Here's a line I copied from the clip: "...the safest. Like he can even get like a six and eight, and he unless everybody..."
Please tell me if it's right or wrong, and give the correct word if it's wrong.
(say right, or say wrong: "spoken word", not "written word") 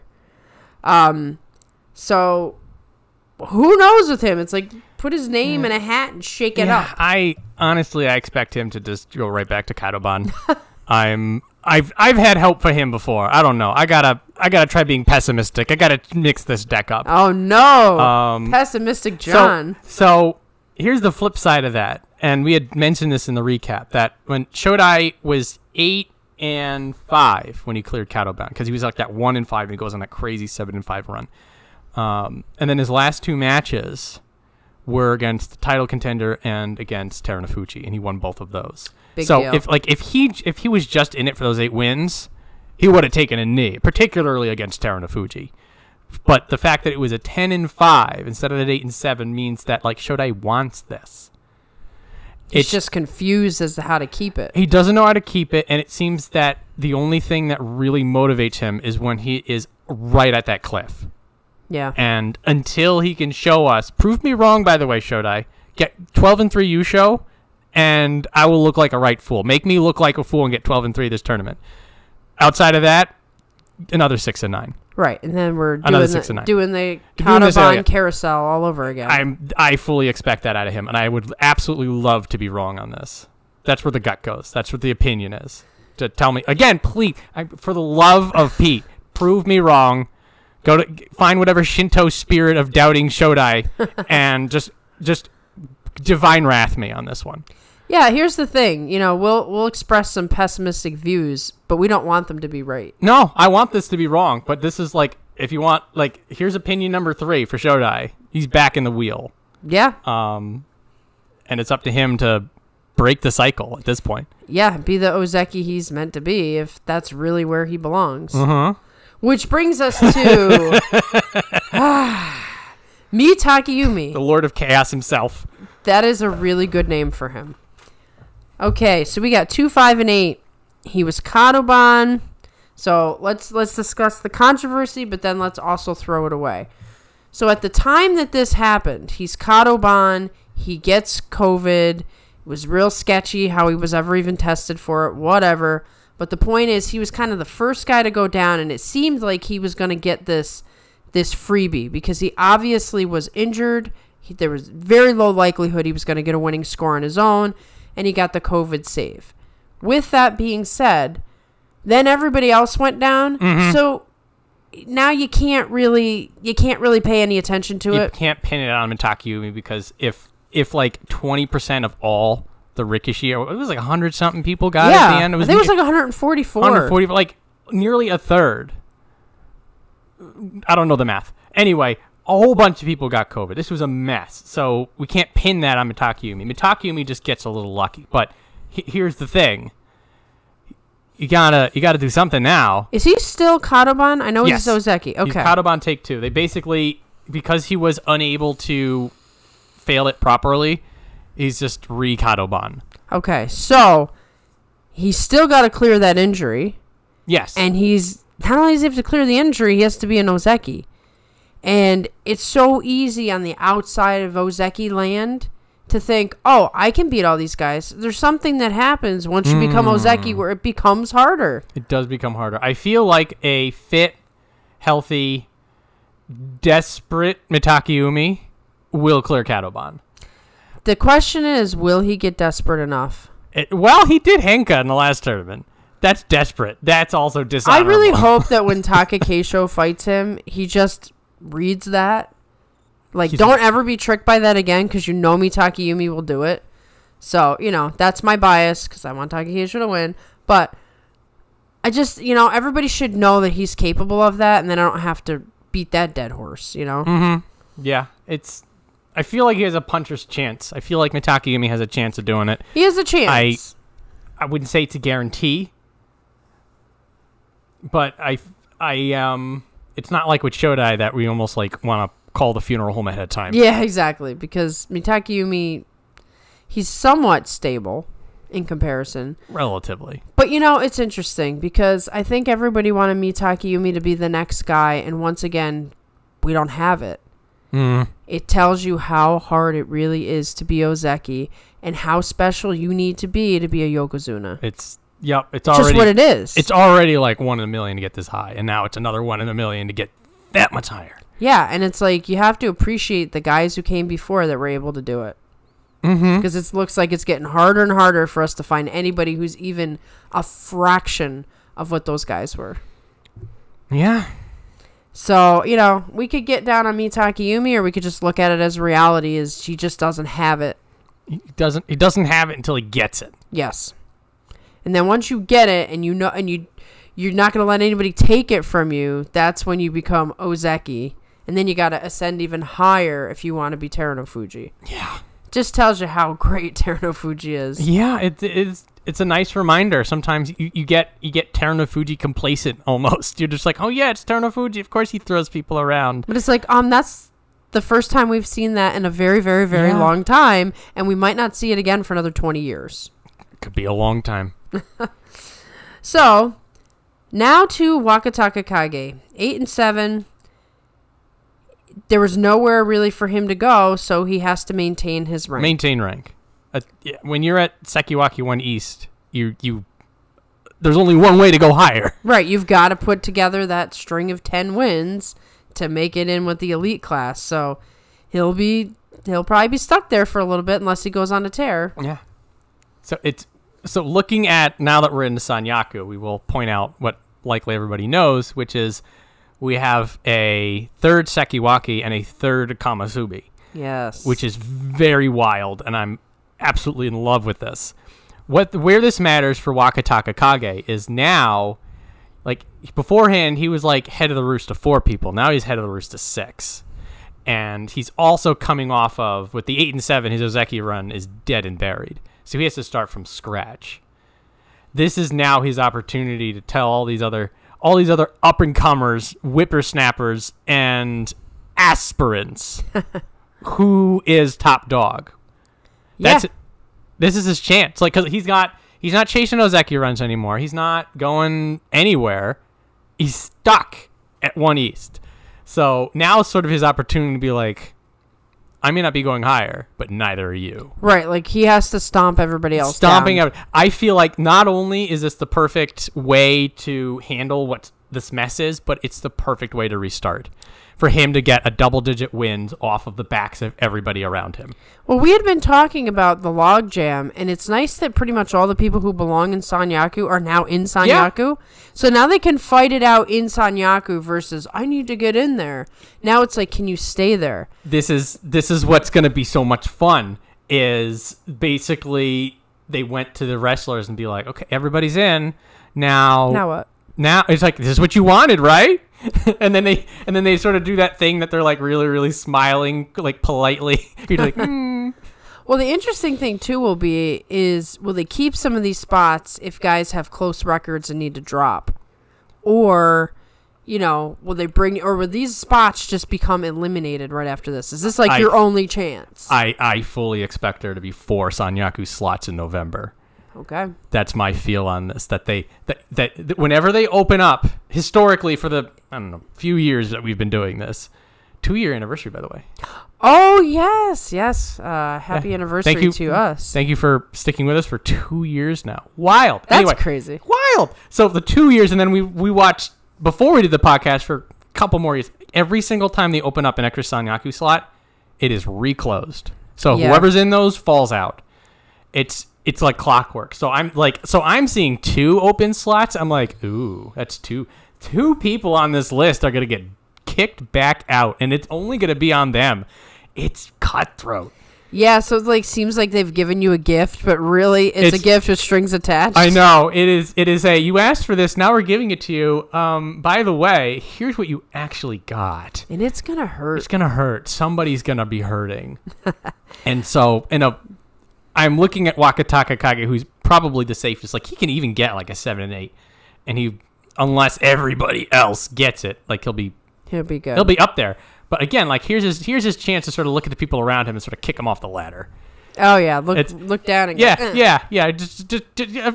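wrong: "seven", not "six".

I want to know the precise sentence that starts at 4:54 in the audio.
It's Yep, it's, it's already just what it is.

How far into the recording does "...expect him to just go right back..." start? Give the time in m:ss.
0:08.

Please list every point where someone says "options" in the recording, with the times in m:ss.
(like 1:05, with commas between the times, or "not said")
not said.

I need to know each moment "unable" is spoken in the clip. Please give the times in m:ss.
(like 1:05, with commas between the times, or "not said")
3:18.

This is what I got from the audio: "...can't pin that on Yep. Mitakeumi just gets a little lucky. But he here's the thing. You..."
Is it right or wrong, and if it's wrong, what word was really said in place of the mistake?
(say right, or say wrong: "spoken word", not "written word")
wrong: "Mitakeumi", not "Yep".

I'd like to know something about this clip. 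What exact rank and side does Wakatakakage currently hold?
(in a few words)
Sekiwake One East.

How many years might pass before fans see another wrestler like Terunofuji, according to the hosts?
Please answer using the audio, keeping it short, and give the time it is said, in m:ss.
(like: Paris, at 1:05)
20 years, at 5:52.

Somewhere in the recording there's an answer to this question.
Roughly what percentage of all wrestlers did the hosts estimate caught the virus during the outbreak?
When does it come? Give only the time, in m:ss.
2:51.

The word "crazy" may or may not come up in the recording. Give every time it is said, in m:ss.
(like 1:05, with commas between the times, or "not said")
0:30, 8:39.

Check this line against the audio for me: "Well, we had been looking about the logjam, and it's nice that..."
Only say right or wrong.
wrong.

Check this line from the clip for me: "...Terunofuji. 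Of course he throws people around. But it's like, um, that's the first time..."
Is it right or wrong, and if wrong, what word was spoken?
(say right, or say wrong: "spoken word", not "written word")
right.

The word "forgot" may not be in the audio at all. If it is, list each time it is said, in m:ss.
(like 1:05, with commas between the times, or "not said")
not said.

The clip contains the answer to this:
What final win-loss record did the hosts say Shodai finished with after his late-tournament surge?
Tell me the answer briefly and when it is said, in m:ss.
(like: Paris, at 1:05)
10 and 5, at 0:47.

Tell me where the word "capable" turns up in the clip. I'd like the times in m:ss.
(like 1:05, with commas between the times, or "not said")
4:13.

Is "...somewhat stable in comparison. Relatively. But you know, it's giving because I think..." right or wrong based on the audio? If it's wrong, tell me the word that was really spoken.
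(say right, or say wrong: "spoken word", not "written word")
wrong: "interesting", not "giving".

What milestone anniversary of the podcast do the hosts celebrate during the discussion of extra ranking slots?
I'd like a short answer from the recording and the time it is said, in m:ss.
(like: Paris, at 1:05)
2 year anniversary, at 8:31.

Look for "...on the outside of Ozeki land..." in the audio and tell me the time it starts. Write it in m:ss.
3:33.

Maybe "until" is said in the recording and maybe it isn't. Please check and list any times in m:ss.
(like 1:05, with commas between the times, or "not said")
1:02, 5:22.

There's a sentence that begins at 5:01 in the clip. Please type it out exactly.
Yeah, and it's like you have to appreciate the guys who came before that were able to do it.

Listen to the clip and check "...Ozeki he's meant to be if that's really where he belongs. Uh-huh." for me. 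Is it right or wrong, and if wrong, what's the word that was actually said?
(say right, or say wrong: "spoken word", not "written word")
right.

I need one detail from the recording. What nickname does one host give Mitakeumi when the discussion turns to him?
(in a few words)
The Lord of Chaos.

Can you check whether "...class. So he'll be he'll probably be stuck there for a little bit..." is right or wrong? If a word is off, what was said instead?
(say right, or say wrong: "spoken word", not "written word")
right.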